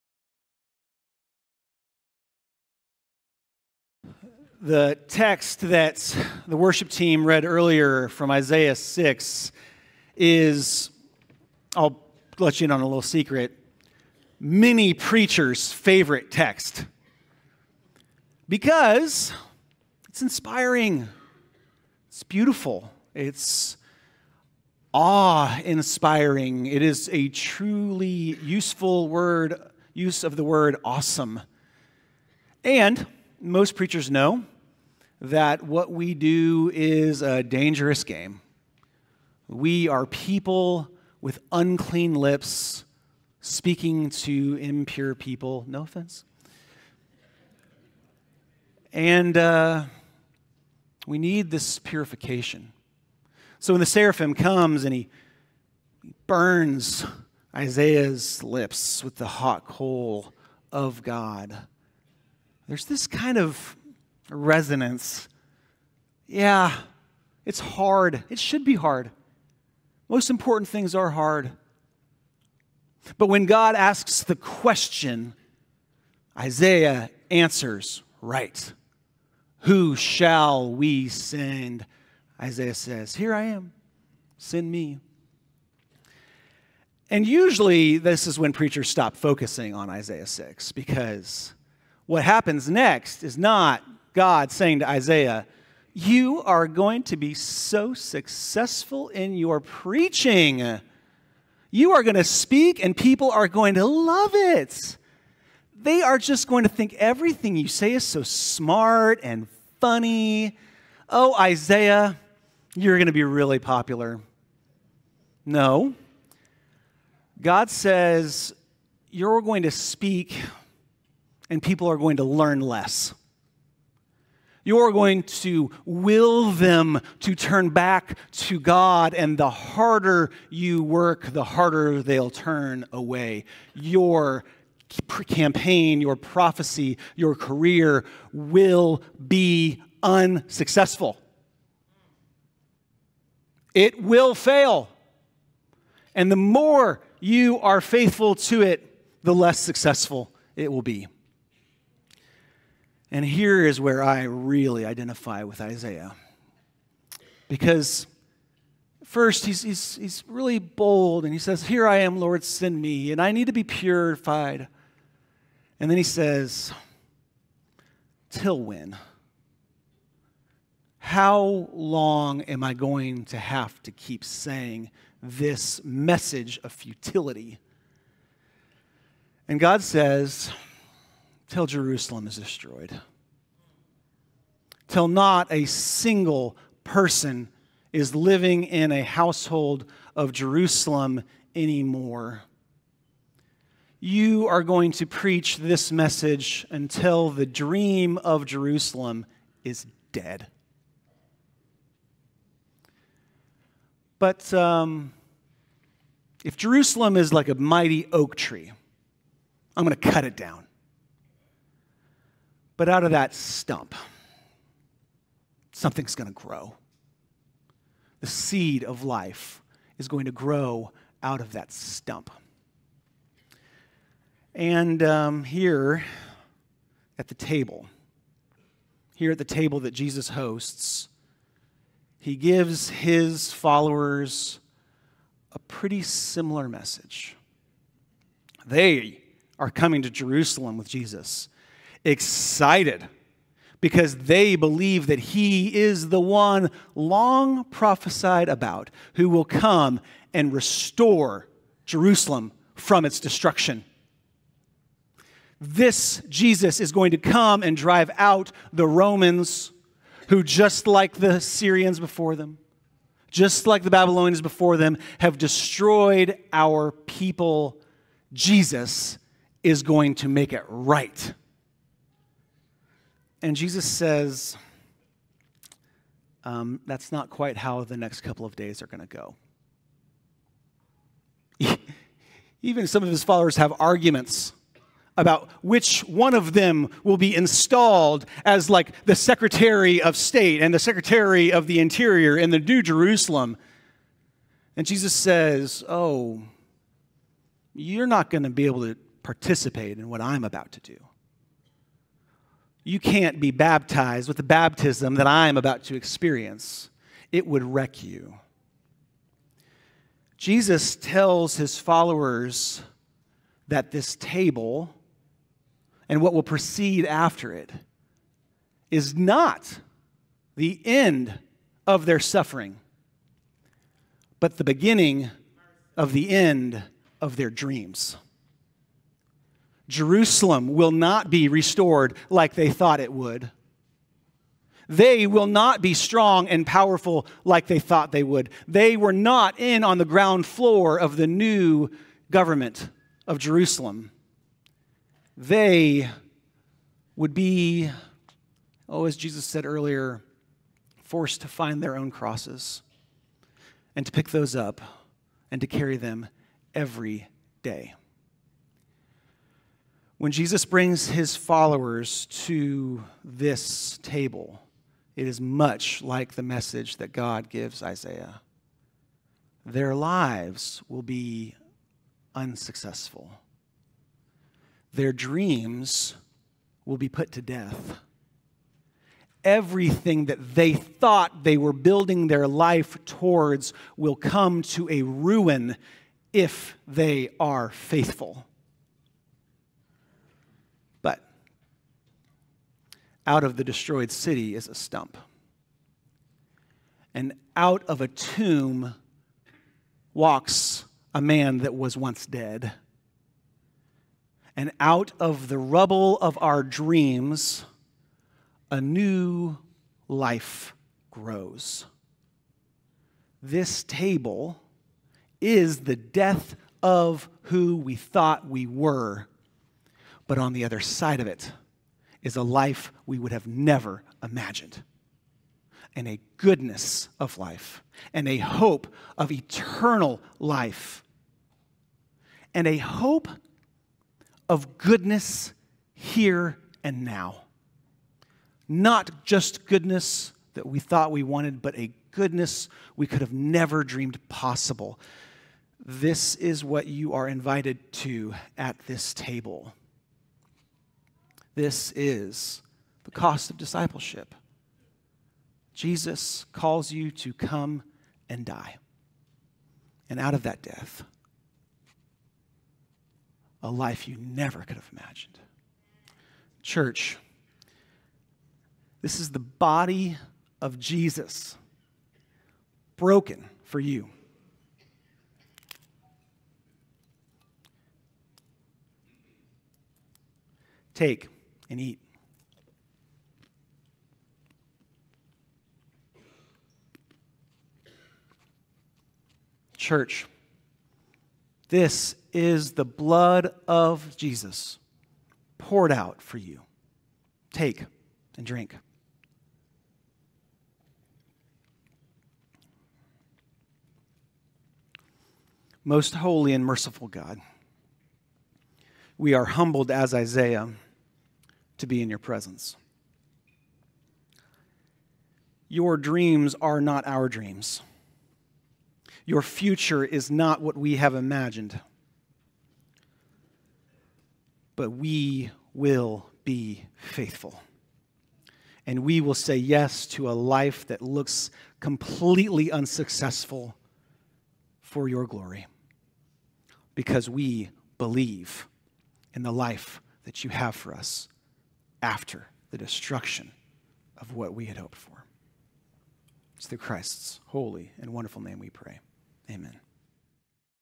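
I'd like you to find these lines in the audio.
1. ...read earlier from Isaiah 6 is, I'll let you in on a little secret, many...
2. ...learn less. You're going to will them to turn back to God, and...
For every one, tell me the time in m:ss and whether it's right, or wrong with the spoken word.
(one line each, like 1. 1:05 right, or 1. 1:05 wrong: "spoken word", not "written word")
1. 0:07 right
2. 2:02 right.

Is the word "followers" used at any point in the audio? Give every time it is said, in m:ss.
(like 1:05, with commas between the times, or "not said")
3:53, 4:43, 5:11, 6:01.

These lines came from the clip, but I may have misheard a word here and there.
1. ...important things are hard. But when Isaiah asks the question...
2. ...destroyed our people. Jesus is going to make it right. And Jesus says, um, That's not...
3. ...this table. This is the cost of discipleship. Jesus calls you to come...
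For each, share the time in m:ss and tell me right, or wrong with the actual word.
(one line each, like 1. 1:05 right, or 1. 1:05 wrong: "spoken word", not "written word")
1. 1:10 wrong: "God", not "Isaiah"
2. 4:25 right
3. 7:28 right.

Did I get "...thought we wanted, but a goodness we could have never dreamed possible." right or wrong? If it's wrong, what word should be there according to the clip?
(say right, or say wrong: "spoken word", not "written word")
right.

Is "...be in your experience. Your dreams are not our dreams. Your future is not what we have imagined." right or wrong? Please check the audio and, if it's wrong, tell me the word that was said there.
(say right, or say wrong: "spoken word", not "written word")
wrong: "presence", not "experience".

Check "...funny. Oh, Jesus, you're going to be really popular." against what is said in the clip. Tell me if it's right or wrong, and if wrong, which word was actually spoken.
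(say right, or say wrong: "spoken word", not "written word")
wrong: "Isaiah", not "Jesus".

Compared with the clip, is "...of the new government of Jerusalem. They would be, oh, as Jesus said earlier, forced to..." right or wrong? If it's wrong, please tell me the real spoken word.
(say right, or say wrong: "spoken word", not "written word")
right.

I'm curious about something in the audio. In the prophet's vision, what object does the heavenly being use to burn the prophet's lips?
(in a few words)
hot coal.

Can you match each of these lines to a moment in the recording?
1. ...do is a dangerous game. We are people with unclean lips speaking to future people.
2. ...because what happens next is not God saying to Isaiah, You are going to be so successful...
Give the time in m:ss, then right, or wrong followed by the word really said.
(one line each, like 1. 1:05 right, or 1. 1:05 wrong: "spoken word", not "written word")
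1. 0:36 wrong: "impure", not "future"
2. 1:30 right.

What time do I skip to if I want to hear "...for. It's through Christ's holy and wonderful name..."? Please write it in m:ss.
9:04.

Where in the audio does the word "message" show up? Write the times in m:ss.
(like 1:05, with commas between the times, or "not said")
2:55, 3:15, 3:56, 6:06.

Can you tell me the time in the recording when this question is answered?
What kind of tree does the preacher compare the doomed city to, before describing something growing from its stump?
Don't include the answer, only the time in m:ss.
3:27.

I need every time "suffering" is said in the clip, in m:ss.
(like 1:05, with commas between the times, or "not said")
5:22.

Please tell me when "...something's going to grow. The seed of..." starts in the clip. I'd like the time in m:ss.
3:35.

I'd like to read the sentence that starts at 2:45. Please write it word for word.
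And then he says, Till when?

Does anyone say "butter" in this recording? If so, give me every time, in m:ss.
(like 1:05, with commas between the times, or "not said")
not said.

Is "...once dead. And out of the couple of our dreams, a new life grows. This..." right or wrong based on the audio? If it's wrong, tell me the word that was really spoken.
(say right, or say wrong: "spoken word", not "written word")
wrong: "rubble", not "couple".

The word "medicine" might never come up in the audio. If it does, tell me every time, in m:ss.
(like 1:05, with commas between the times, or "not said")
not said.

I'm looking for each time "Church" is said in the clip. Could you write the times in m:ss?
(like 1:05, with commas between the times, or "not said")
7:46, 8:09.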